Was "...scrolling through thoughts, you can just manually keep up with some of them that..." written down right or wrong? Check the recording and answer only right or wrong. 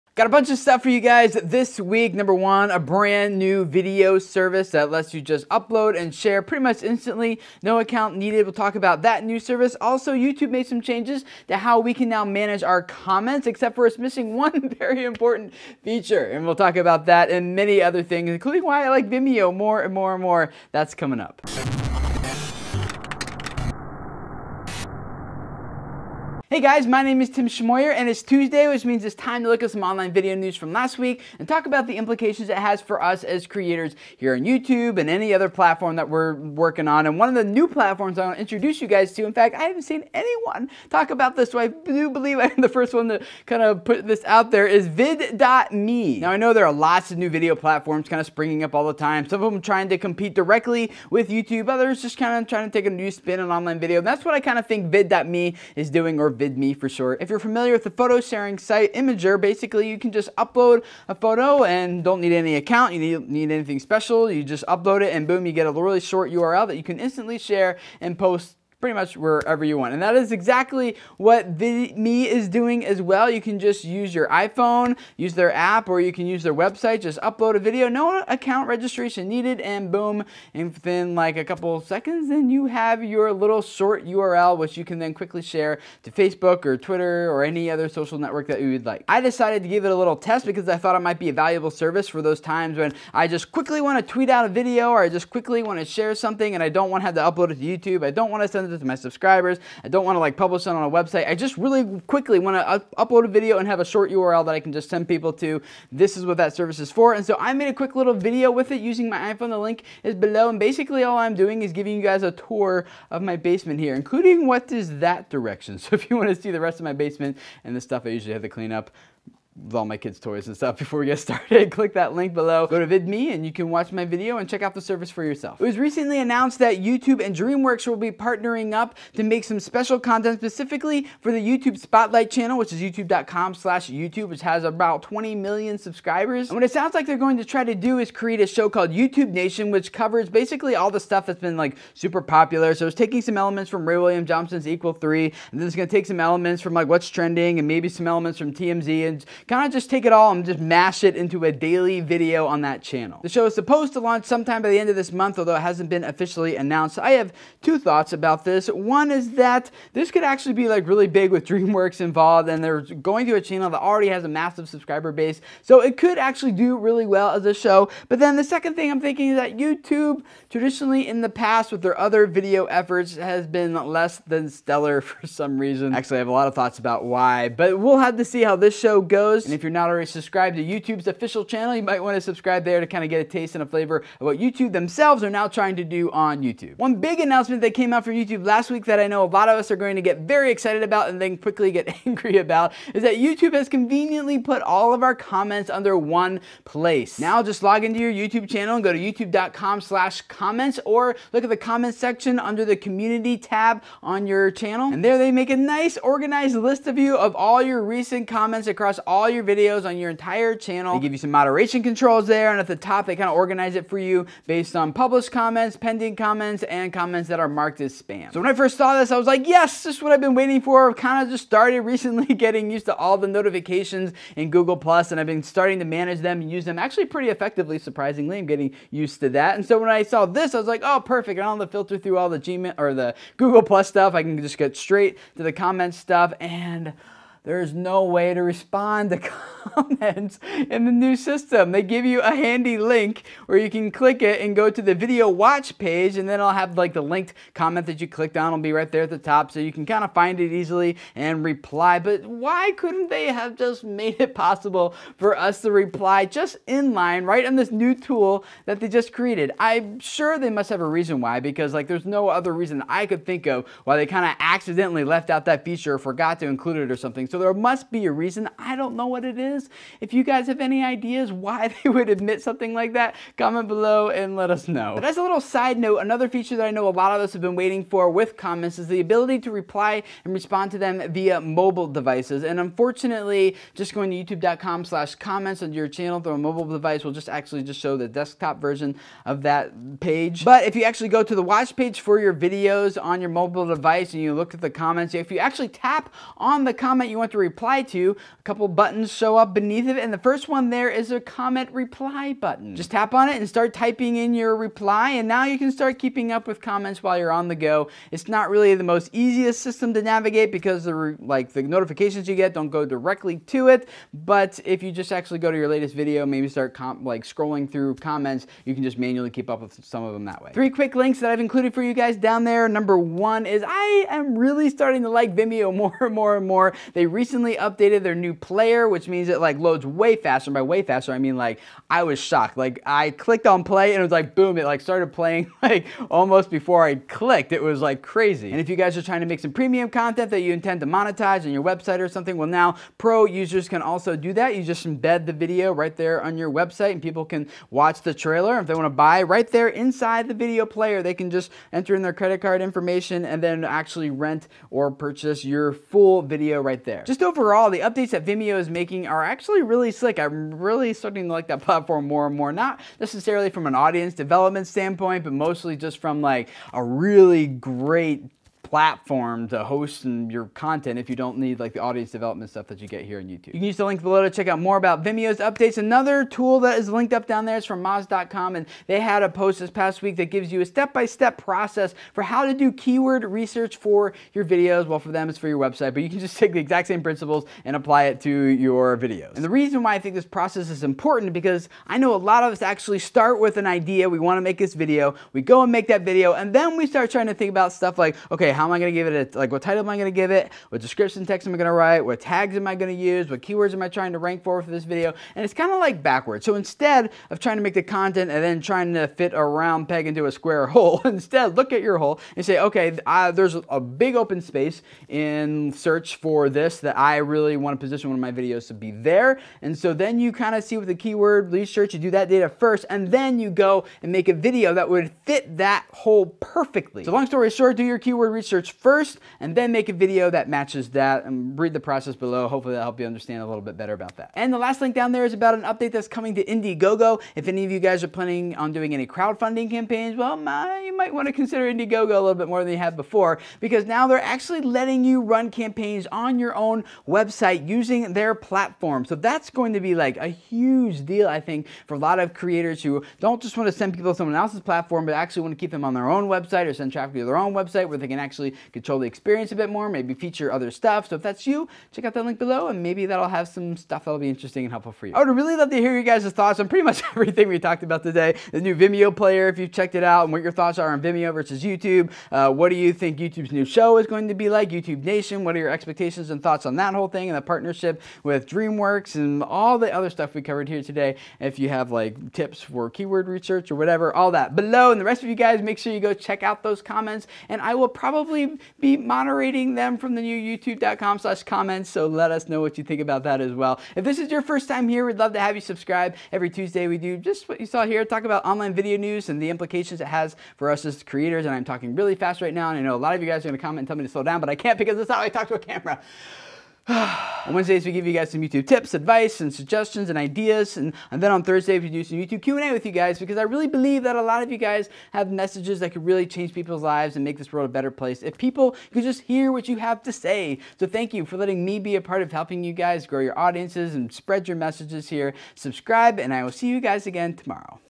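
wrong.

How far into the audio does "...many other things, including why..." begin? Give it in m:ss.
0:17.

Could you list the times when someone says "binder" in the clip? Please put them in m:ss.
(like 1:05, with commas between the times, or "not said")
not said.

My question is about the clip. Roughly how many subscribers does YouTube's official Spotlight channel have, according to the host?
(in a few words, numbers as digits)
20 million.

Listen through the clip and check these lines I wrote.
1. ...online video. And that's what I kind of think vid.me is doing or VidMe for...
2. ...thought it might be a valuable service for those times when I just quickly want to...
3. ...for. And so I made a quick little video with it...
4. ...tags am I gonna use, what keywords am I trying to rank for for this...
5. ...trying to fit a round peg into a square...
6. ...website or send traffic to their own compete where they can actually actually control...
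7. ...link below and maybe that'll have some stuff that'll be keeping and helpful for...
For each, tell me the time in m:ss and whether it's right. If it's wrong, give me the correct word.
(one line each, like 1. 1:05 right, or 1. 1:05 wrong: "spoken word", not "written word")
1. 0:53 right
2. 1:30 right
3. 1:46 right
4. 6:42 right
5. 6:48 right
6. 7:36 wrong: "website", not "compete"
7. 7:42 wrong: "interesting", not "keeping".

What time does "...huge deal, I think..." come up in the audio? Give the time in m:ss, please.
7:30.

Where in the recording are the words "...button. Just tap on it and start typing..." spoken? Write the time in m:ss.
5:02.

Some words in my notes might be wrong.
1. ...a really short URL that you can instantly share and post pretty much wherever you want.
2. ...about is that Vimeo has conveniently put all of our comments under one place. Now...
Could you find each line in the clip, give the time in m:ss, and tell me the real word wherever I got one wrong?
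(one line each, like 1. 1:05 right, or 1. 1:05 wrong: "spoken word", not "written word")
1. 1:05 right
2. 3:12 wrong: "YouTube", not "Vimeo".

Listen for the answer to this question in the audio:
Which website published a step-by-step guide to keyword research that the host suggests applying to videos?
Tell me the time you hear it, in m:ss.
6:17.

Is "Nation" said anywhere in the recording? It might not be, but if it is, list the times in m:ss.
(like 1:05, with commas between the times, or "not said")
2:19, 7:55.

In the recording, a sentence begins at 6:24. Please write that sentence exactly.
Well, for them, it's for your website, but you can just take the exact same principles and apply it to your videos.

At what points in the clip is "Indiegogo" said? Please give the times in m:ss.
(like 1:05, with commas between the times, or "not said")
7:16, 7:21.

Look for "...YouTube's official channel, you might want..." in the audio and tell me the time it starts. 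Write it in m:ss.
3:00.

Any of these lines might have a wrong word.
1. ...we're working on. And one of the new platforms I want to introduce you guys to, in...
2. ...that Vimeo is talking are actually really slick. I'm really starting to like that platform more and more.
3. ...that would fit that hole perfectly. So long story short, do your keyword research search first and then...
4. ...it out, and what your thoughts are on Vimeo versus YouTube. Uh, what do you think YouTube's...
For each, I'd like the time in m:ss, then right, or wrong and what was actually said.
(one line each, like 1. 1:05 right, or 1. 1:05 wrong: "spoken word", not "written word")
1. 0:36 right
2. 5:58 wrong: "making", not "talking"
3. 7:04 right
4. 7:49 right.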